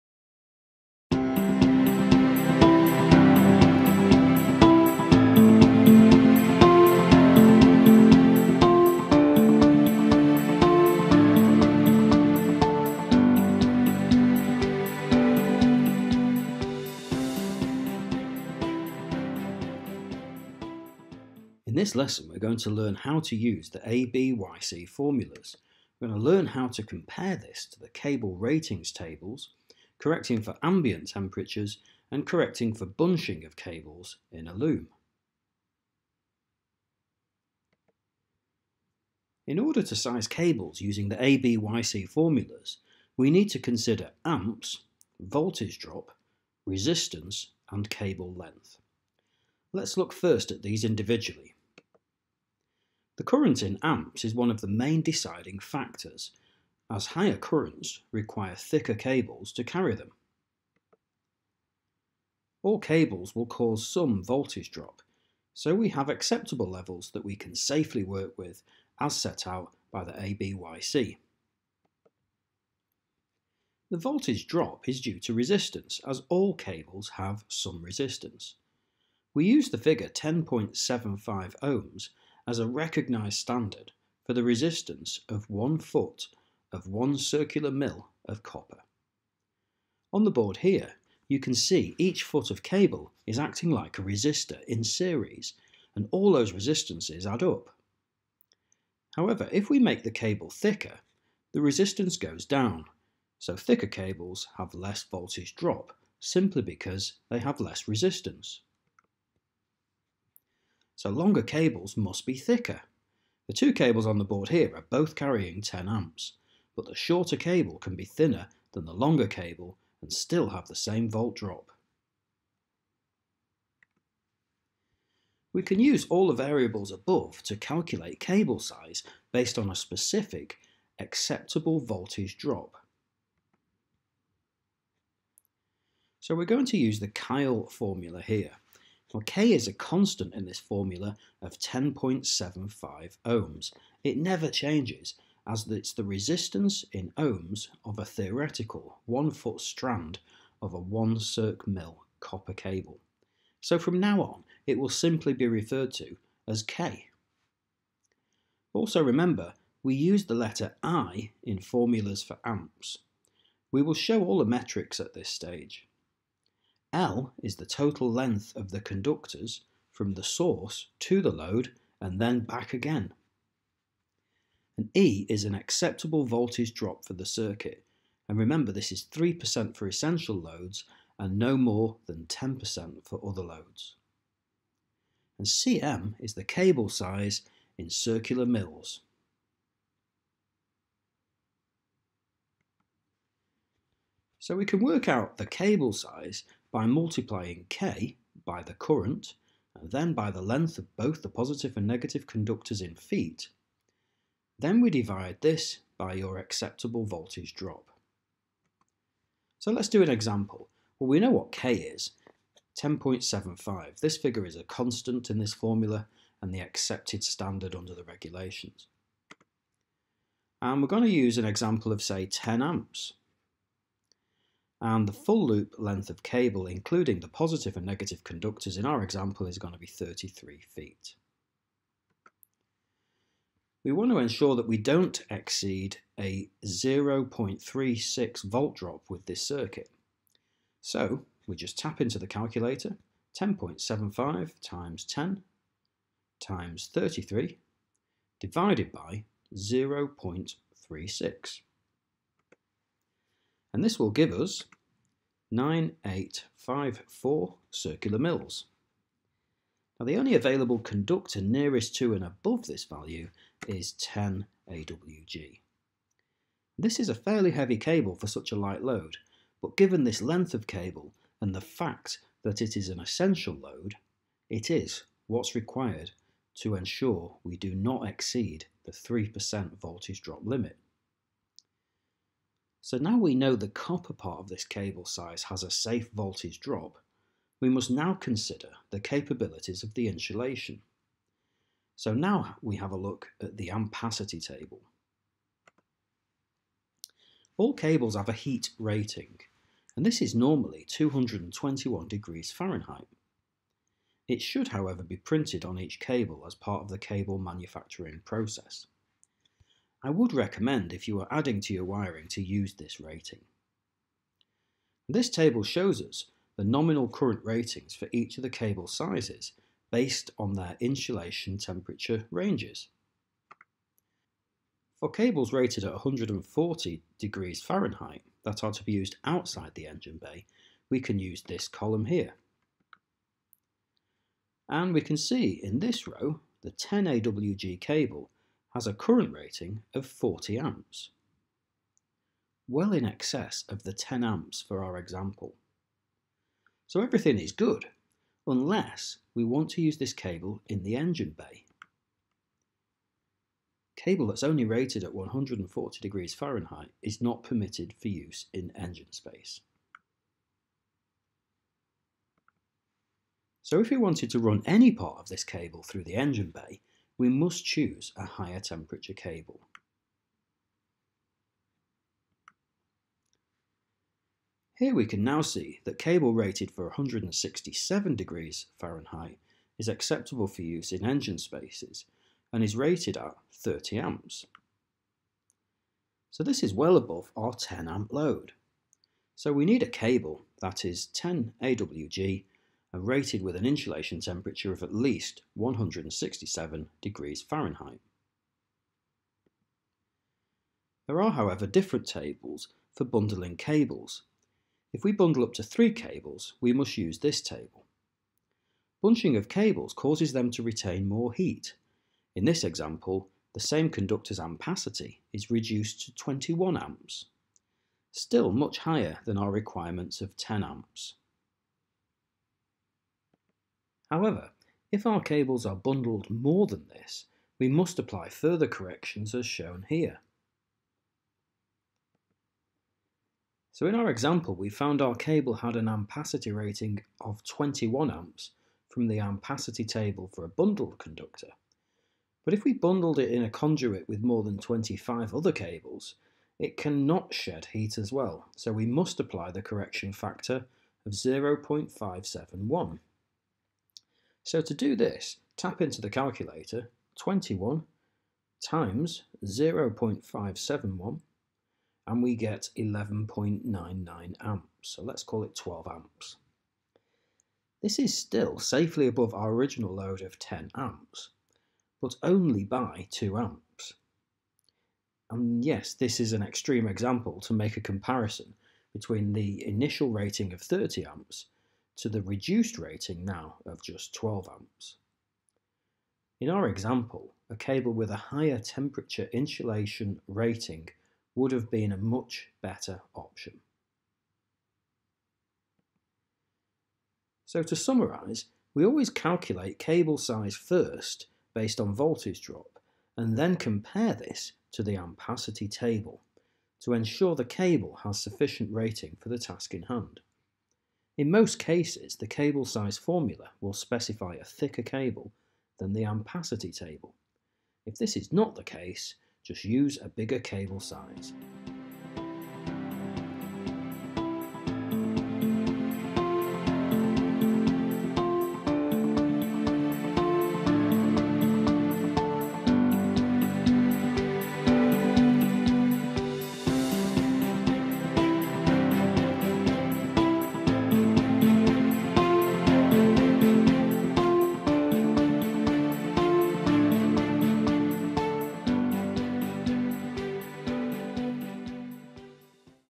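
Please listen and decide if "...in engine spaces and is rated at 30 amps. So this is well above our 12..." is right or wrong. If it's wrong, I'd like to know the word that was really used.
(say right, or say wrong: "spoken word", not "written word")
wrong: "10", not "12".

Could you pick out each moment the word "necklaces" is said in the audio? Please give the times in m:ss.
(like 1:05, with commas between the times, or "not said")
not said.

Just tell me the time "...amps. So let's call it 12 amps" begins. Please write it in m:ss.
7:44.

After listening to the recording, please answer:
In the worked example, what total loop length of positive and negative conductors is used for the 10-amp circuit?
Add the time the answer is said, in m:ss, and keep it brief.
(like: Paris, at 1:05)
33 feet, at 3:49.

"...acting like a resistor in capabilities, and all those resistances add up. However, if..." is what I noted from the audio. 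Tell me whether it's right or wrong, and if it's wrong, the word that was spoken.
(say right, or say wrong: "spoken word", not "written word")
wrong: "series", not "capabilities".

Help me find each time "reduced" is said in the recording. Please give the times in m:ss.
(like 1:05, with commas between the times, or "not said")
6:55, 8:02.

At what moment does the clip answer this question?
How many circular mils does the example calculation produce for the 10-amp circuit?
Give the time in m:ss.
4:15.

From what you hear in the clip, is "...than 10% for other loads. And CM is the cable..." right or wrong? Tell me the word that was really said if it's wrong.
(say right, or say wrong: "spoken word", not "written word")
right.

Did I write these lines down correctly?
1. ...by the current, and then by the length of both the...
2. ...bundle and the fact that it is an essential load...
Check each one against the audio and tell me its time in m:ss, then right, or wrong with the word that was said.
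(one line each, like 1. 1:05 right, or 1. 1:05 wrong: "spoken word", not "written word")
1. 3:18 right
2. 4:30 wrong: "cable", not "bundle".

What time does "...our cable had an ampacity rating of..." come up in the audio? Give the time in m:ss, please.
7:15.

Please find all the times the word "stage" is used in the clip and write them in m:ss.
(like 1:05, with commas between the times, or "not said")
2:45.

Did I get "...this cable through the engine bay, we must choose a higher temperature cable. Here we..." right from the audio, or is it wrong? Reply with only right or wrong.
right.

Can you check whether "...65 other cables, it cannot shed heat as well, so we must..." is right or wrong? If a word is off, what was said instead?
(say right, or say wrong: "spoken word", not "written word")
wrong: "25", not "65".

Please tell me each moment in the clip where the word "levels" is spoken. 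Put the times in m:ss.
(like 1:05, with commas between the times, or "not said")
1:06.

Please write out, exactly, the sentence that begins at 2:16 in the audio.
So we're going to use the Kyle formula here.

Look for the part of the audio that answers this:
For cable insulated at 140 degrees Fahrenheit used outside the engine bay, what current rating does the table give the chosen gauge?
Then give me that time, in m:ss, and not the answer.
5:40.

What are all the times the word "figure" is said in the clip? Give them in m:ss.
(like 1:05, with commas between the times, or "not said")
1:19, 3:34.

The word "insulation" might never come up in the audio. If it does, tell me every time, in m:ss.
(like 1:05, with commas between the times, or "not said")
4:50, 5:20, 6:33, 8:09.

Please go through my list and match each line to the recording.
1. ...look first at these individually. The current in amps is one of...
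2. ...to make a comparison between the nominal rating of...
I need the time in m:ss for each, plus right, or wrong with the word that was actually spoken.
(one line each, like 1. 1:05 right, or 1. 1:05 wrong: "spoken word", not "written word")
1. 0:49 right
2. 7:57 wrong: "initial", not "nominal".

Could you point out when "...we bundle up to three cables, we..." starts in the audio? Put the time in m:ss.
6:45.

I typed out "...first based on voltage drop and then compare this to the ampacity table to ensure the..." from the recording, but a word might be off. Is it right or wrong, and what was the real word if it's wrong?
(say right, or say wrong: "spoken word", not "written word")
right.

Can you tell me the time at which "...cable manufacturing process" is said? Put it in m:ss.
5:06.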